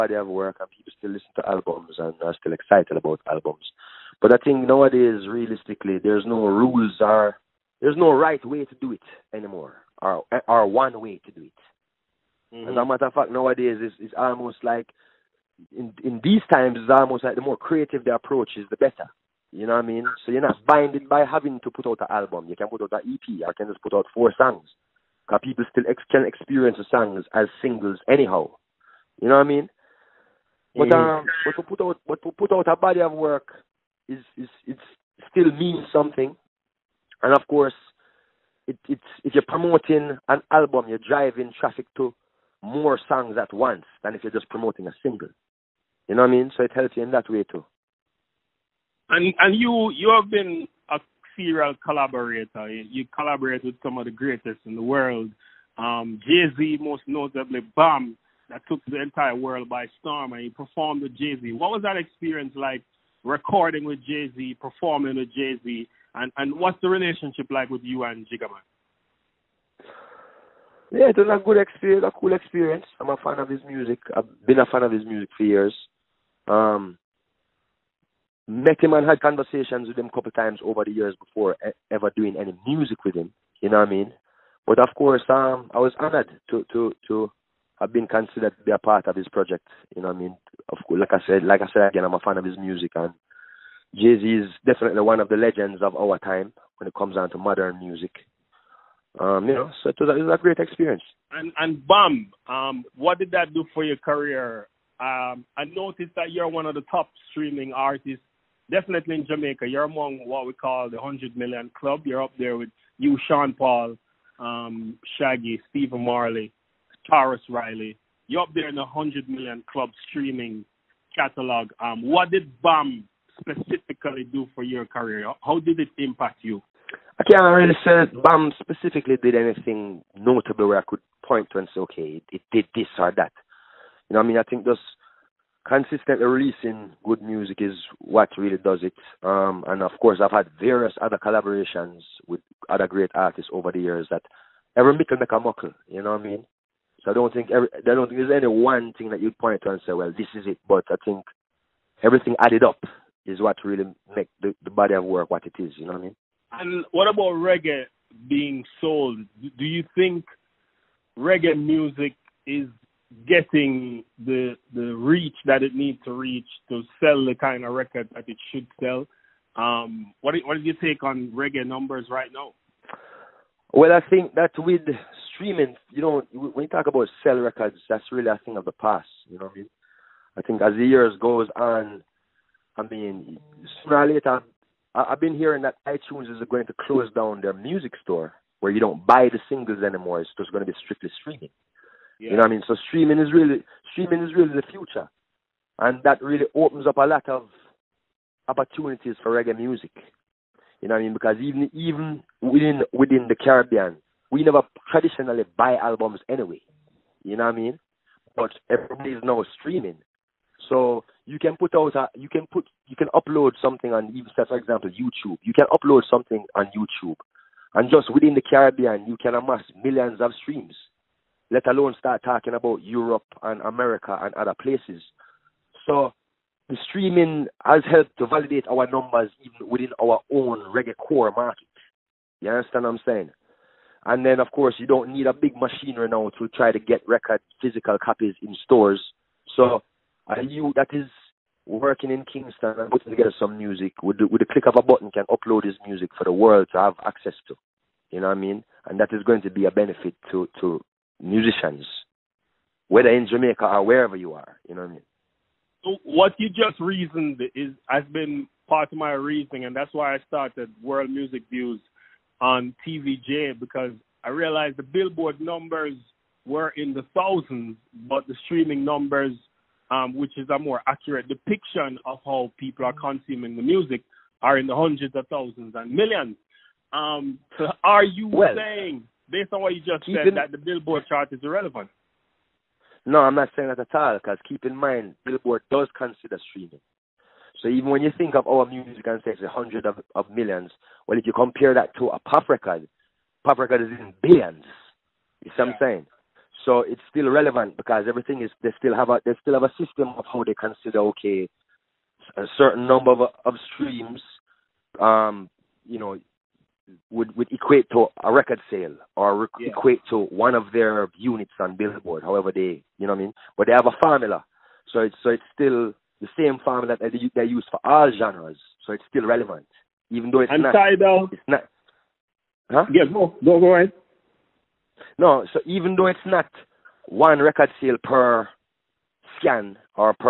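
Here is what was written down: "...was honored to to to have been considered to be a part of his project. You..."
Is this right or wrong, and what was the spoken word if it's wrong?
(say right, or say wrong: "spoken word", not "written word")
right.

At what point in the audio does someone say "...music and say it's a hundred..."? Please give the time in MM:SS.
04:48.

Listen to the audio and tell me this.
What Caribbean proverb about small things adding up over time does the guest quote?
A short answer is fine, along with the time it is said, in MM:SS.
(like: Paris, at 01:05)
every mickle make a muckle, at 02:24.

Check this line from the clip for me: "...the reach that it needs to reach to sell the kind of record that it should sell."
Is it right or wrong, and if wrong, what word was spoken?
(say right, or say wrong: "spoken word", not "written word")
right.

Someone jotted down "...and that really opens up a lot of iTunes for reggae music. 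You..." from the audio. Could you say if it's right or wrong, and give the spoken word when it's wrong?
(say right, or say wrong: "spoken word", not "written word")
wrong: "opportunities", not "iTunes".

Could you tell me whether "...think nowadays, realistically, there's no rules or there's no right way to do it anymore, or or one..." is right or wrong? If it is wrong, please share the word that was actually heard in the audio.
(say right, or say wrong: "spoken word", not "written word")
right.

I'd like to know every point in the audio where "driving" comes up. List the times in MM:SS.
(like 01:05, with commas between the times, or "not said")
00:40.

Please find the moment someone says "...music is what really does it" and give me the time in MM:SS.
02:17.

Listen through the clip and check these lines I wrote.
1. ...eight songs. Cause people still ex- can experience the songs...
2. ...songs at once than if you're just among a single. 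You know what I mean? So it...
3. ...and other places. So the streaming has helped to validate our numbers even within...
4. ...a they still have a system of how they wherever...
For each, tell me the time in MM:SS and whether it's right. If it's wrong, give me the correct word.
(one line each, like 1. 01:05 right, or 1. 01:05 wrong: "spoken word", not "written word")
1. 00:24 wrong: "four", not "eight"
2. 00:43 wrong: "promoting", not "among"
3. 03:44 right
4. 04:59 wrong: "consider", not "wherever".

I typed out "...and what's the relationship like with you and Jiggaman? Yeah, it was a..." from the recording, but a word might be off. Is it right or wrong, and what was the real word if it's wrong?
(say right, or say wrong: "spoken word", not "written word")
right.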